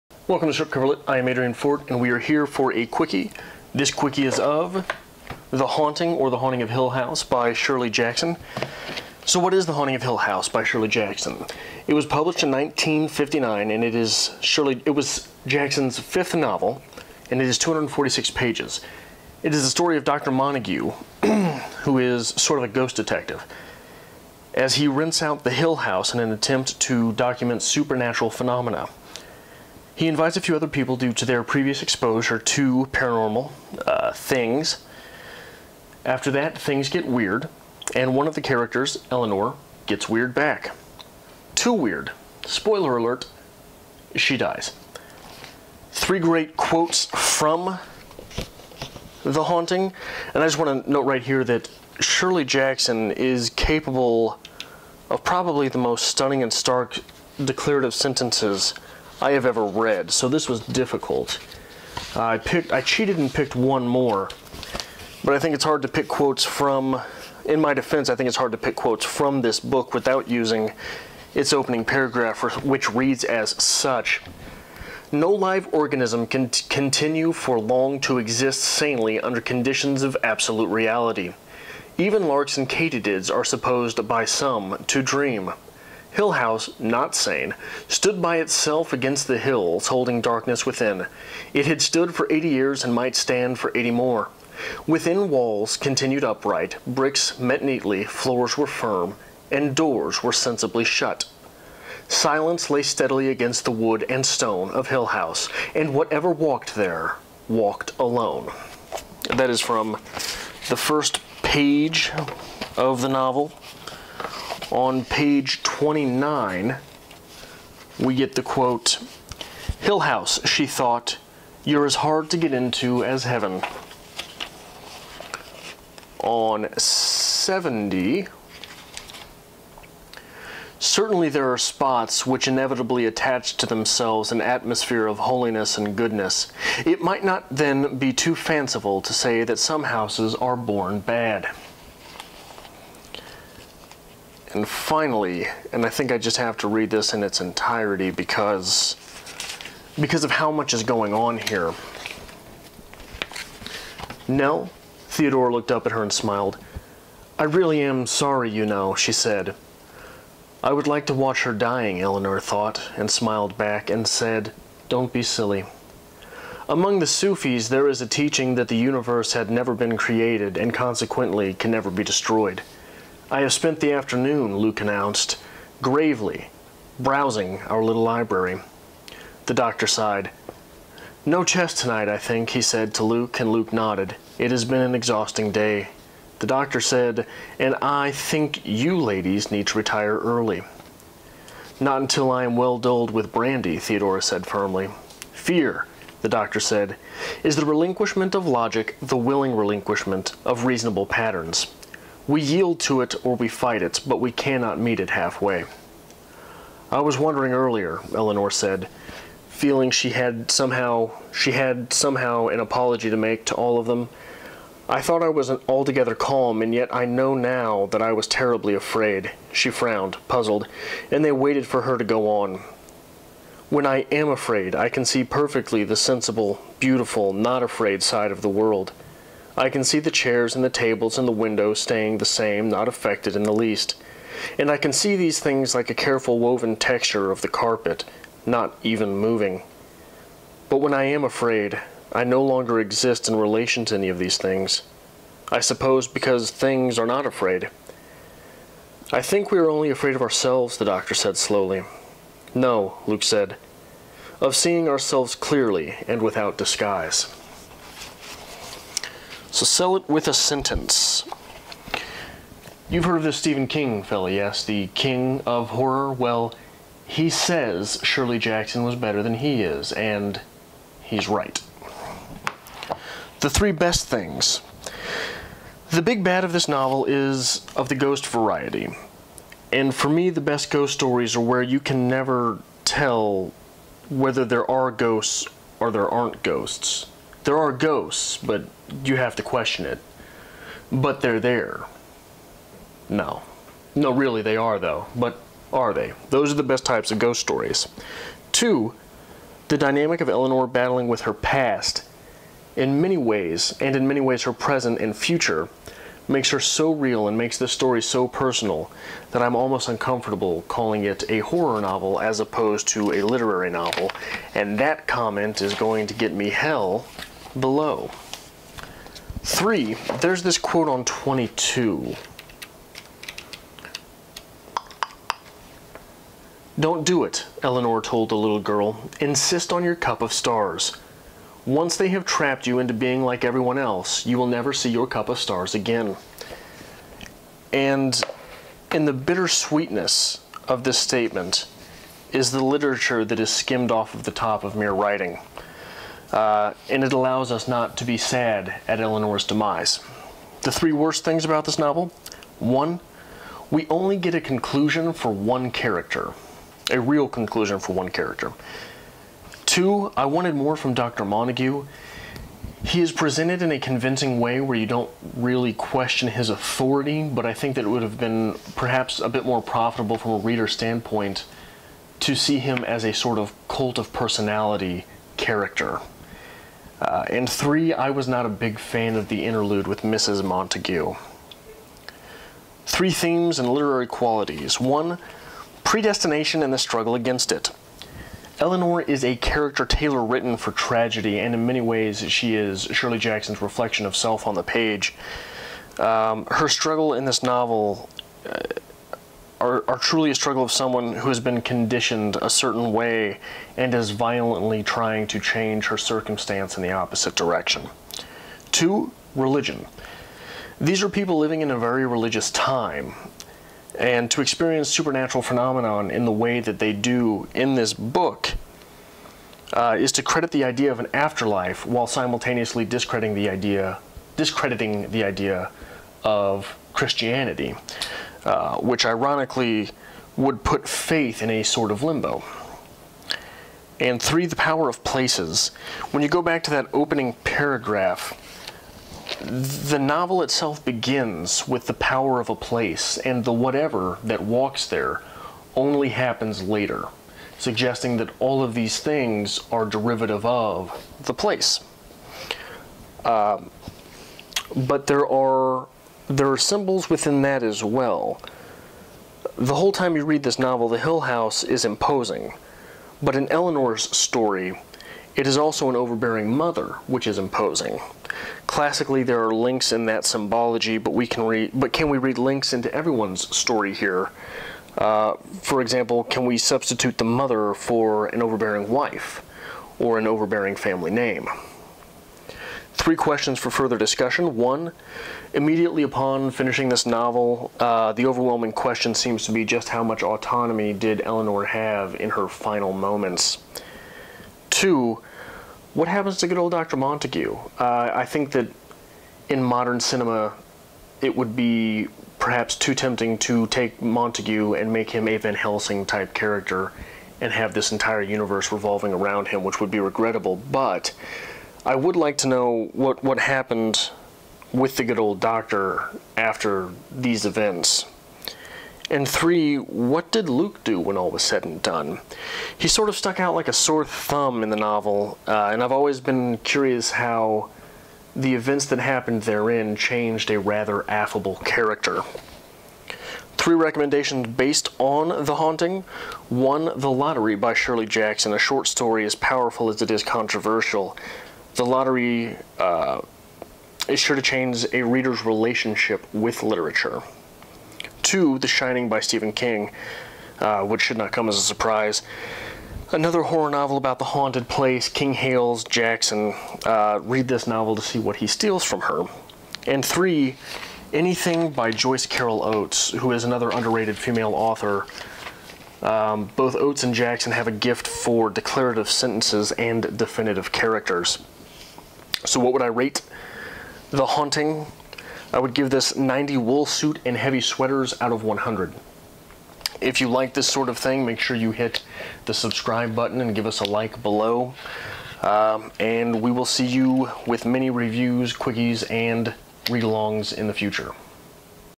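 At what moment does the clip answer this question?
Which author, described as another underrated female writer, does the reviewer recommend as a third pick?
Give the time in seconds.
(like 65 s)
561 s.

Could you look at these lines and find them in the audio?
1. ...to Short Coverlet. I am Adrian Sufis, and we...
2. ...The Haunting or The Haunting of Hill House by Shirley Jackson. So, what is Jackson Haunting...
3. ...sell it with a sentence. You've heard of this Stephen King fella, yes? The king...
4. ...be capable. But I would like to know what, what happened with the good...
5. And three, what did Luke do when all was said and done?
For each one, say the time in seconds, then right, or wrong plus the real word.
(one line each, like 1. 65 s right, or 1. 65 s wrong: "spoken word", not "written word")
1. 0 s wrong: "Fort", not "Sufis"
2. 5 s wrong: "The", not "Jackson"
3. 259 s right
4. 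509 s wrong: "regrettable", not "capable"
5. 519 s right.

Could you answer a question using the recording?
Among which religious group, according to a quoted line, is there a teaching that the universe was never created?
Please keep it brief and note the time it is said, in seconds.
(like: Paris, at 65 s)
The Sufis, at 167 s.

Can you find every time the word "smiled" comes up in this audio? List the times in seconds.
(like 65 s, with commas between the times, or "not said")
156 s, 163 s.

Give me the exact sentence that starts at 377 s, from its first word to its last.
Uh, and three, I was not a big fan of the interlude with Mrs.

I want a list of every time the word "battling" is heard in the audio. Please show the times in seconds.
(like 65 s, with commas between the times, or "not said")
300 s.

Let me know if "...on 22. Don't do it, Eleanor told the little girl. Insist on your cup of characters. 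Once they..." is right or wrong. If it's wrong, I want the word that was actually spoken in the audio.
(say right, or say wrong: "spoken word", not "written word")
wrong: "stars", not "characters".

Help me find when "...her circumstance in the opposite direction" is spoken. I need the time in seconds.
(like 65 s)
405 s.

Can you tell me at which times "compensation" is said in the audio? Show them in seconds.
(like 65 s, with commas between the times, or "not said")
not said.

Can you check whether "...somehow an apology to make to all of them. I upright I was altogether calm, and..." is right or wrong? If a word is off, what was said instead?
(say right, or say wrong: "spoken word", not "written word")
wrong: "thought", not "upright".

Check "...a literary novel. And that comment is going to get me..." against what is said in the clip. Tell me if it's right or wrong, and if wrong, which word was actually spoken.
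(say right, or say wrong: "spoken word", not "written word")
right.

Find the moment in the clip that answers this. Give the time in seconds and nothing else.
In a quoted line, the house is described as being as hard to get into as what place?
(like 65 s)
123 s.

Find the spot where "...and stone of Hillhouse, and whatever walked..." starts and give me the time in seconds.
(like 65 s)
104 s.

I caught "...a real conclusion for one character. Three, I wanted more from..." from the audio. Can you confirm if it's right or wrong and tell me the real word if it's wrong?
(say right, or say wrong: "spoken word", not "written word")
wrong: "Two", not "Three".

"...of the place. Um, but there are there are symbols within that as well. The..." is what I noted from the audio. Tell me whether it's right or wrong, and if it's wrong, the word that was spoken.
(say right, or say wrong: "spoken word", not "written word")
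right.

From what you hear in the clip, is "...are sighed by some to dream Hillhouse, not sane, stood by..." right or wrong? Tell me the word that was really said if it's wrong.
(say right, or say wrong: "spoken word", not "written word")
wrong: "supposed", not "sighed".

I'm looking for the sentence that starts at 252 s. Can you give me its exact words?
No, Luke said, of seeing ourselves clearly and without disguise.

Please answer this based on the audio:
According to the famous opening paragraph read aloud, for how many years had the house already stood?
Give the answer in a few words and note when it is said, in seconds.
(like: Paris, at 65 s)
80, at 92 s.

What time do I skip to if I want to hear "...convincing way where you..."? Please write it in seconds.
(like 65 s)
363 s.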